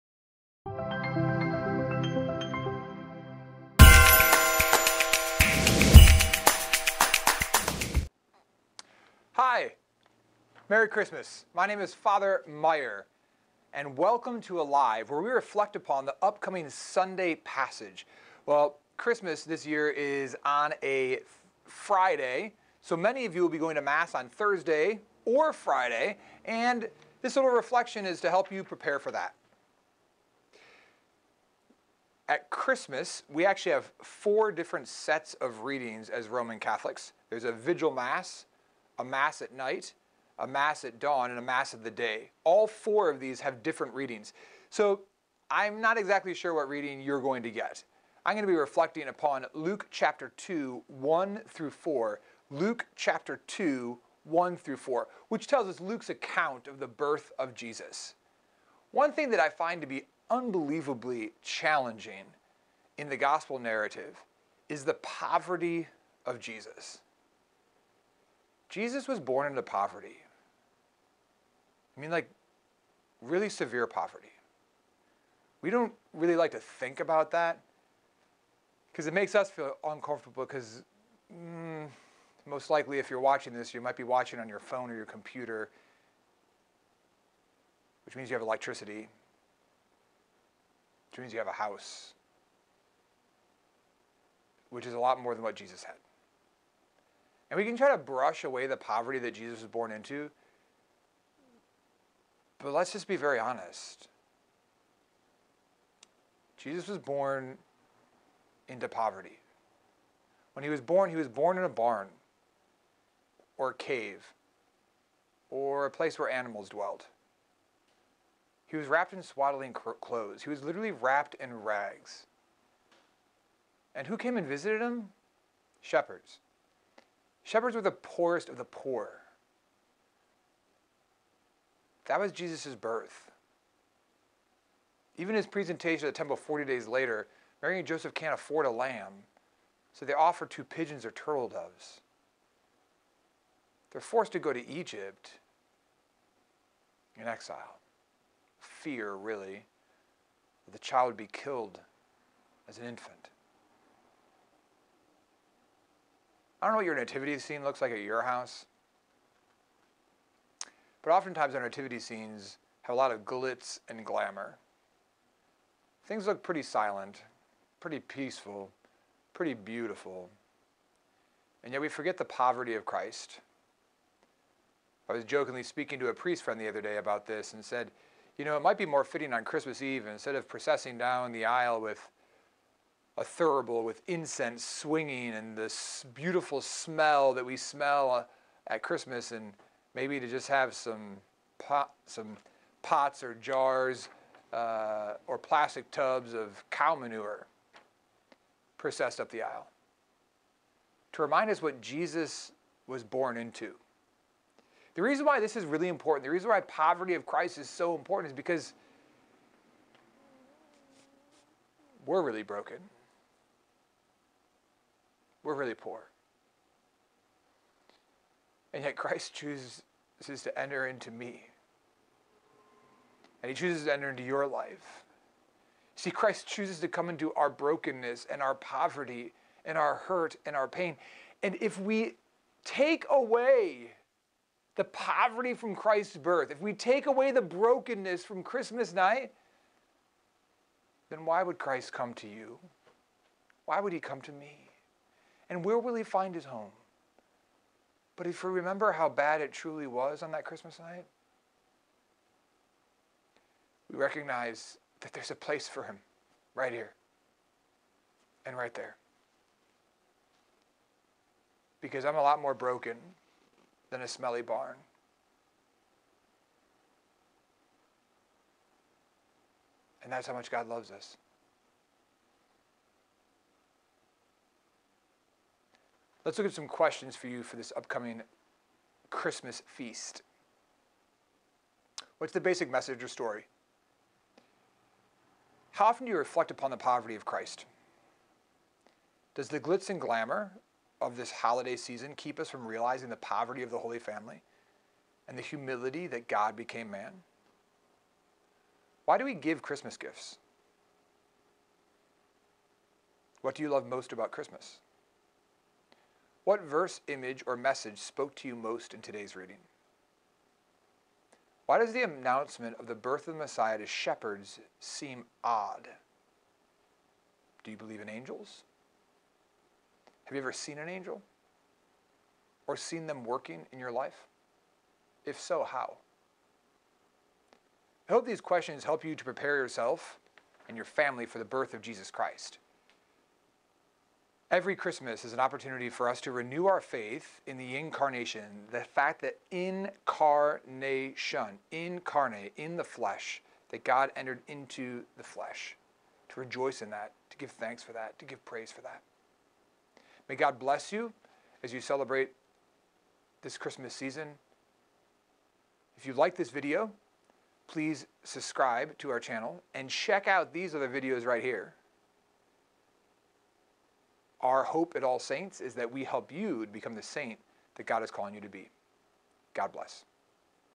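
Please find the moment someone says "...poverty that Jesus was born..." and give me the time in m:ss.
1:38.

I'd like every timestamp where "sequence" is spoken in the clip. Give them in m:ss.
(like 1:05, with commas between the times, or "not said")
not said.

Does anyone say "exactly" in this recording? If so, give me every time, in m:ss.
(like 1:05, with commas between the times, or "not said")
0:45.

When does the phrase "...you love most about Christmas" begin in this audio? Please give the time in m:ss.
5:03.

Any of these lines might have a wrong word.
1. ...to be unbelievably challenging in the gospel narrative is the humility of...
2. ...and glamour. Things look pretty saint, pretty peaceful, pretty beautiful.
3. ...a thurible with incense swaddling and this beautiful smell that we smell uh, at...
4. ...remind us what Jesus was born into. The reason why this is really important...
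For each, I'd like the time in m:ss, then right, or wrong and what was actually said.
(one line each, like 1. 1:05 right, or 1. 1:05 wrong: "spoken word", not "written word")
1. 0:59 wrong: "poverty", not "humility"
2. 2:43 wrong: "silent", not "saint"
3. 3:03 wrong: "swinging", not "swaddling"
4. 3:21 right.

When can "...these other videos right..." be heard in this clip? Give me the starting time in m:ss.
6:00.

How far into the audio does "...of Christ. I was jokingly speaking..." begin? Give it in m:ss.
2:52.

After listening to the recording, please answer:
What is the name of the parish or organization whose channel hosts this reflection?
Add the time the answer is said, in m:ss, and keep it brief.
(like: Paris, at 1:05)
All Saints, at 6:05.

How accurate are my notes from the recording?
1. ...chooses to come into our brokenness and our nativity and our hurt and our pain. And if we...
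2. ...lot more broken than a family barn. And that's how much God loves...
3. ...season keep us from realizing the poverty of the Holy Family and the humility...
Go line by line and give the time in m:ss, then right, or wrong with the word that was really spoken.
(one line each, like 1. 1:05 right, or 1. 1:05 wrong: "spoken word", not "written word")
1. 3:46 wrong: "poverty", not "nativity"
2. 4:22 wrong: "smelly", not "family"
3. 4:51 right.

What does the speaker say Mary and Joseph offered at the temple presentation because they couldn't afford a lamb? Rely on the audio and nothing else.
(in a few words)
Two pigeons or turtle doves.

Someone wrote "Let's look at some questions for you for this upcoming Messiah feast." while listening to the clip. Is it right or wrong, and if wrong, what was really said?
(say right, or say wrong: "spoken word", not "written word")
wrong: "Christmas", not "Messiah".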